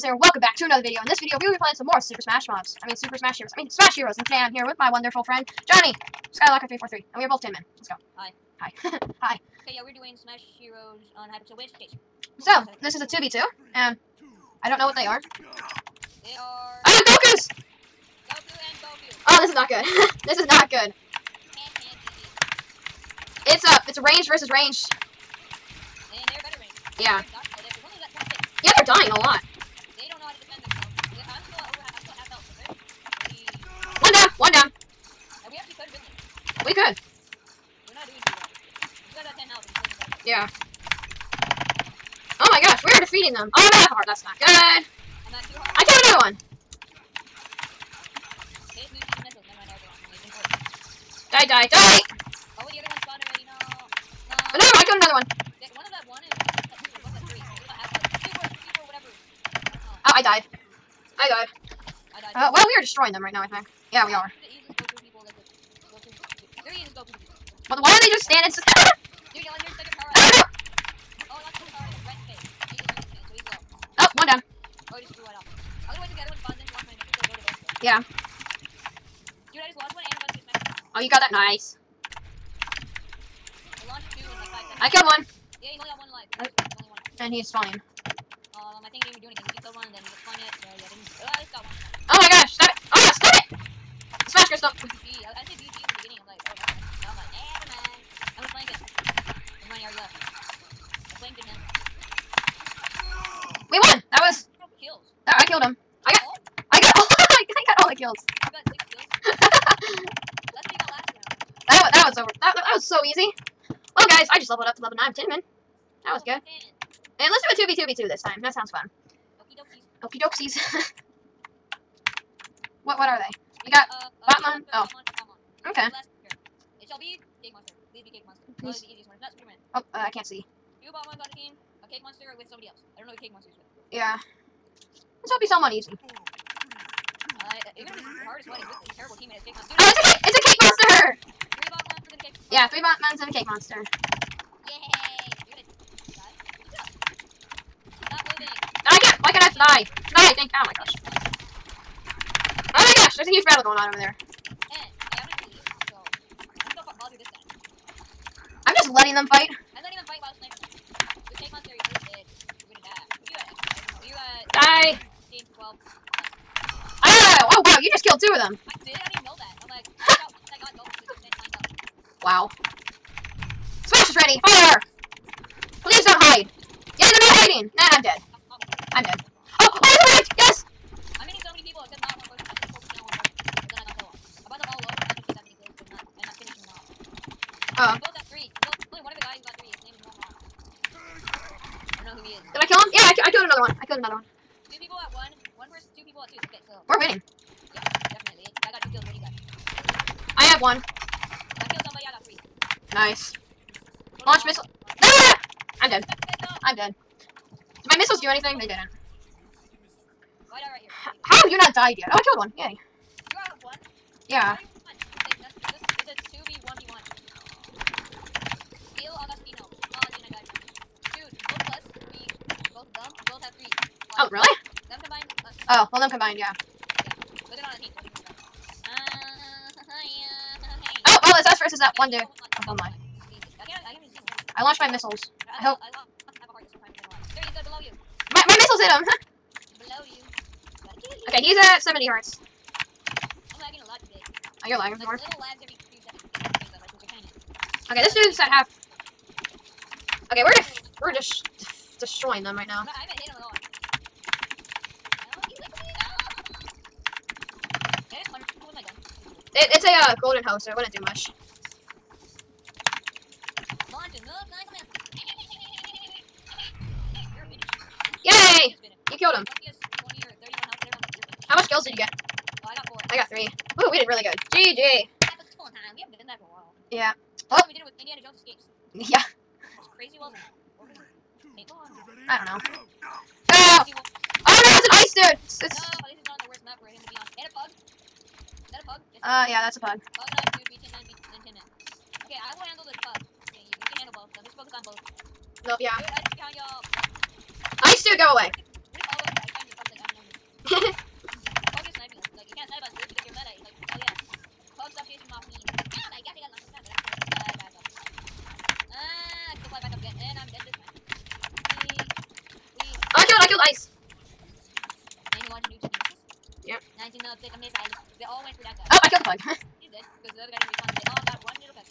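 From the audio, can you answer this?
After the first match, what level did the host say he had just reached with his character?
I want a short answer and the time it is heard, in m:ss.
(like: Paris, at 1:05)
9, at 1:54.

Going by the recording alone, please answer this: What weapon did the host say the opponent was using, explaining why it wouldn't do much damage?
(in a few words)
golden hoe.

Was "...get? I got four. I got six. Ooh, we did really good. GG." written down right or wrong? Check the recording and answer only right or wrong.
wrong.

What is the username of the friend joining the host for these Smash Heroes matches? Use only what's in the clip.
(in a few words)
Skylocker343.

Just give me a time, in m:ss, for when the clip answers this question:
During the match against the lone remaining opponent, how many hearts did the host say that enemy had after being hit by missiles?
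4:01.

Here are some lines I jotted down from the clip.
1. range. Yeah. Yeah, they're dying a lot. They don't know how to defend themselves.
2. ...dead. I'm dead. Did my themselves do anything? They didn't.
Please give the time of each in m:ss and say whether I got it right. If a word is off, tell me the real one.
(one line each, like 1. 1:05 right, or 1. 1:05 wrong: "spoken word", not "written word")
1. 0:26 right
2. 3:25 wrong: "missiles", not "themselves".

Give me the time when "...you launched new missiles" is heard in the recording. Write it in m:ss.
5:15.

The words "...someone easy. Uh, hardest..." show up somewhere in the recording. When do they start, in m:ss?
2:15.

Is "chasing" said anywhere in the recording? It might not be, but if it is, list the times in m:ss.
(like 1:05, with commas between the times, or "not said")
5:05.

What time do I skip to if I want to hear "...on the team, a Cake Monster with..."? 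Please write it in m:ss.
2:11.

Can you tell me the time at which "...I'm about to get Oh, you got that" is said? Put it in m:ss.
1:20.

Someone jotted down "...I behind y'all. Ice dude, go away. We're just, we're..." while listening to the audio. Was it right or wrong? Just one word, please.
right.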